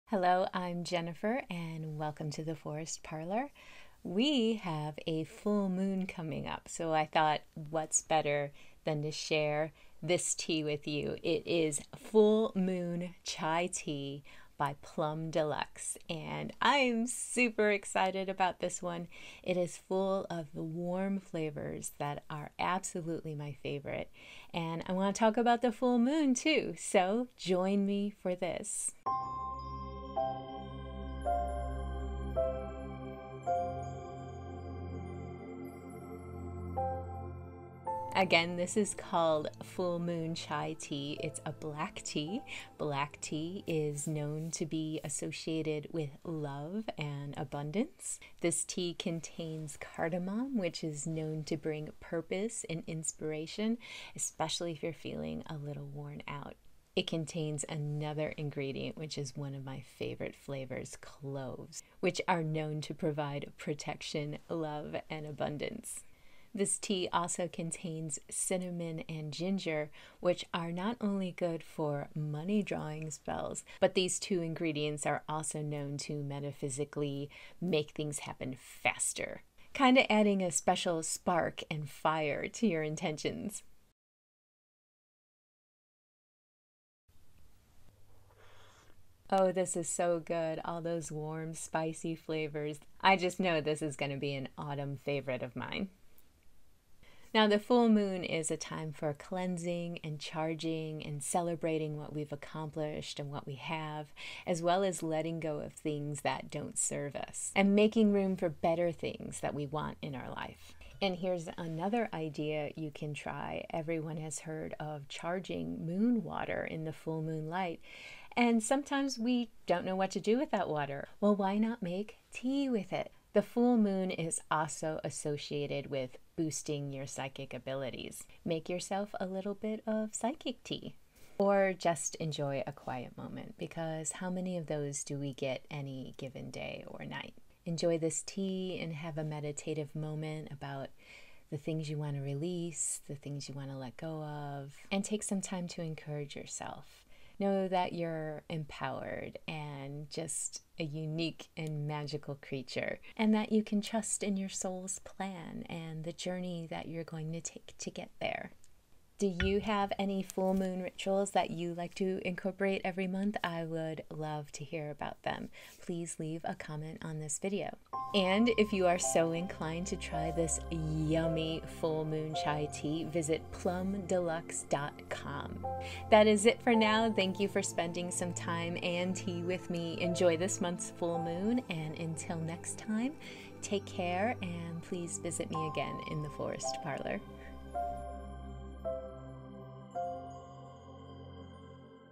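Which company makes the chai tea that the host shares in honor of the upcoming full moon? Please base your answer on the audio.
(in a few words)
Plum Deluxe.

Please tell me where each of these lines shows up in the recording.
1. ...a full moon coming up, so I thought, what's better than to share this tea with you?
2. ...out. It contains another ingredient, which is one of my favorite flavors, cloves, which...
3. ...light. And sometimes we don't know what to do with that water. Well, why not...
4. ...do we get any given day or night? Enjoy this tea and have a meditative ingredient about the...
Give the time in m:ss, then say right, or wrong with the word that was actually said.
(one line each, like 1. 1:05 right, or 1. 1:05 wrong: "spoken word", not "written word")
1. 0:05 right
2. 0:56 right
3. 1:57 right
4. 2:15 wrong: "moment", not "ingredient".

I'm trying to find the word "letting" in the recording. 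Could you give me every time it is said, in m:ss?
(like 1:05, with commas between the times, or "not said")
1:45.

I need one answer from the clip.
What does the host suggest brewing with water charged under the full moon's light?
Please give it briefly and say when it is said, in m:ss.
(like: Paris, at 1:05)
psychic tea, at 2:10.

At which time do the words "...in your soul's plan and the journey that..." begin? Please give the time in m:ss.
2:34.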